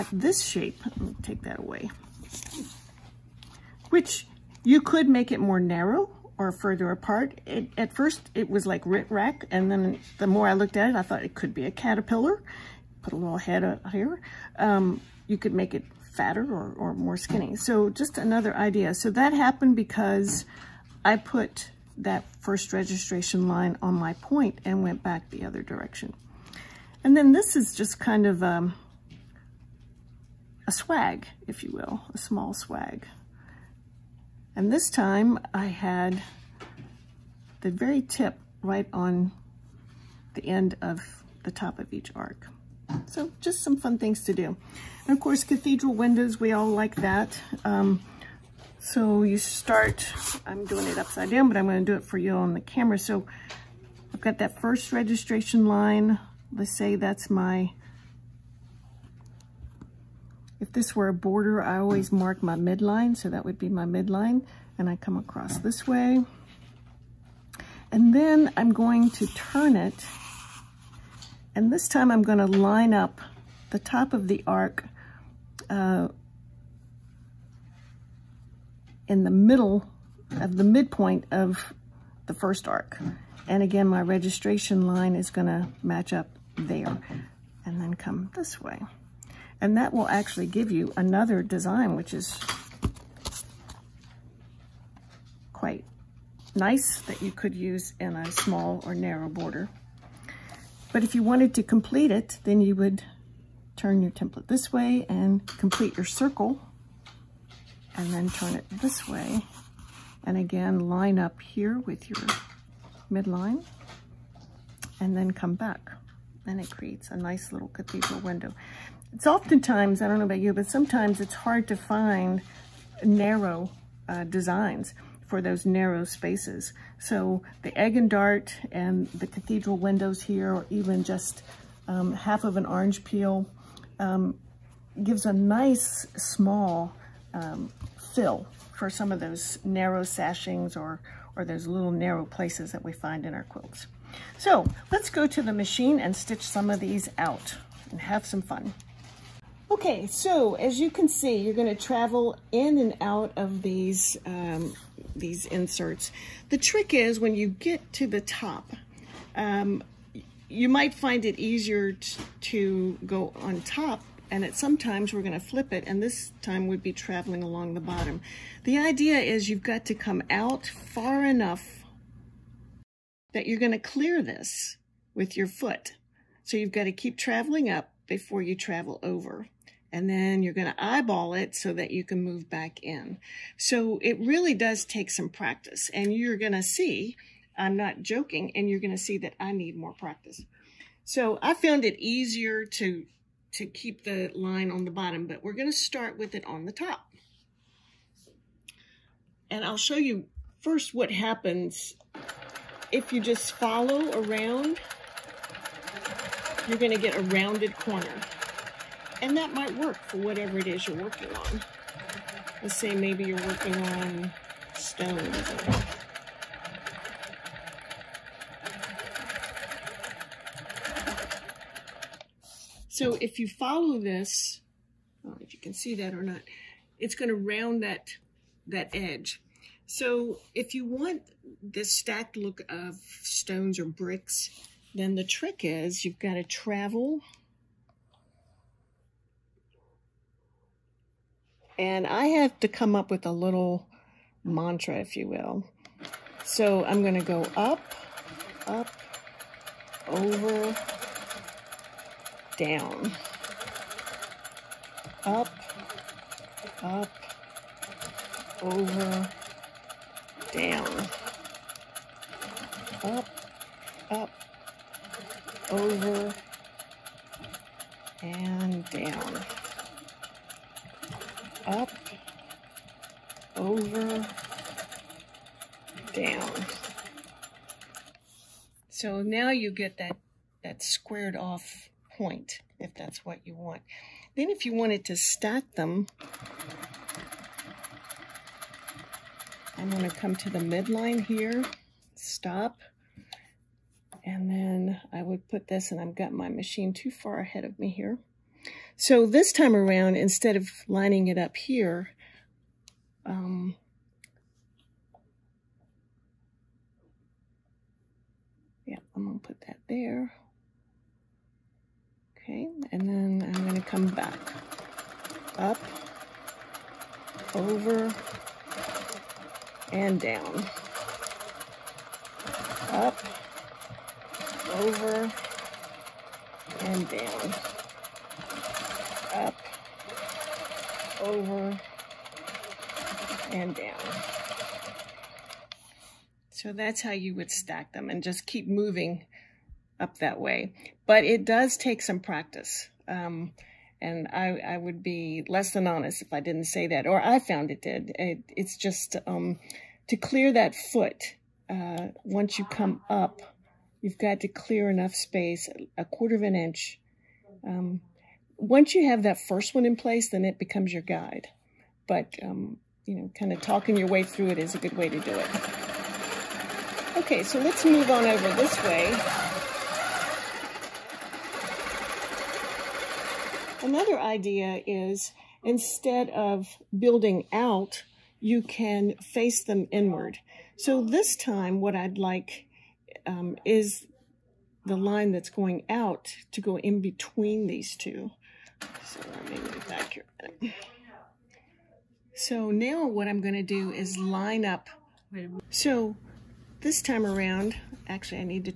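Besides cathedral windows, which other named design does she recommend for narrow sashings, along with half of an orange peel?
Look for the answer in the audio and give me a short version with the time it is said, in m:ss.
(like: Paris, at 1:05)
Egg and dart, at 2:07.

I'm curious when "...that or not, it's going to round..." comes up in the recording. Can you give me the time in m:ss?
3:45.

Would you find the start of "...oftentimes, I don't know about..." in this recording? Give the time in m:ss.
1:59.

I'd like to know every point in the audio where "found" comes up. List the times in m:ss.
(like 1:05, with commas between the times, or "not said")
3:11, 5:47.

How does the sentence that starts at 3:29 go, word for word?
And that might work for whatever it is you're working on.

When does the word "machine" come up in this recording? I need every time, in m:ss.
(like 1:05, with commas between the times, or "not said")
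2:25, 4:56.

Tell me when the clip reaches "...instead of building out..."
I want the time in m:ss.
6:15.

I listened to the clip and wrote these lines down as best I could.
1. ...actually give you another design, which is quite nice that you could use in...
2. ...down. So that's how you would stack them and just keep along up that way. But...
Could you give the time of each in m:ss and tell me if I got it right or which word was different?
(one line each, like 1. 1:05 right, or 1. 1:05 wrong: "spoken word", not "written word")
1. 1:30 right
2. 5:33 wrong: "moving", not "along".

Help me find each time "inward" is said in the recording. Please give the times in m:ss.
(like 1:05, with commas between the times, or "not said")
6:19.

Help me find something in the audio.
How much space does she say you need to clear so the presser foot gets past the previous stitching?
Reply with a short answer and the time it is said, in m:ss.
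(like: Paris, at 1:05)
A quarter of an inch, at 5:55.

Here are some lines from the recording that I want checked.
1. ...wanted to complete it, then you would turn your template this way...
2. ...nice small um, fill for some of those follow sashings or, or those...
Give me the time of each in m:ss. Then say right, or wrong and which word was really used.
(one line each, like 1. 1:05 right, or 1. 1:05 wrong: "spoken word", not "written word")
1. 1:41 right
2. 2:15 wrong: "narrow", not "follow".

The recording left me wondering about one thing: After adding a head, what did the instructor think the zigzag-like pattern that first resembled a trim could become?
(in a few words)
Caterpillar.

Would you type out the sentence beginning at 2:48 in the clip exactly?
The idea is you've got to come out far enough that you're going to clear this with your foot.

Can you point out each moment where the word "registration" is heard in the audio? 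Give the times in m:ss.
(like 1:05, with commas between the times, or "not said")
0:22, 0:54, 1:24.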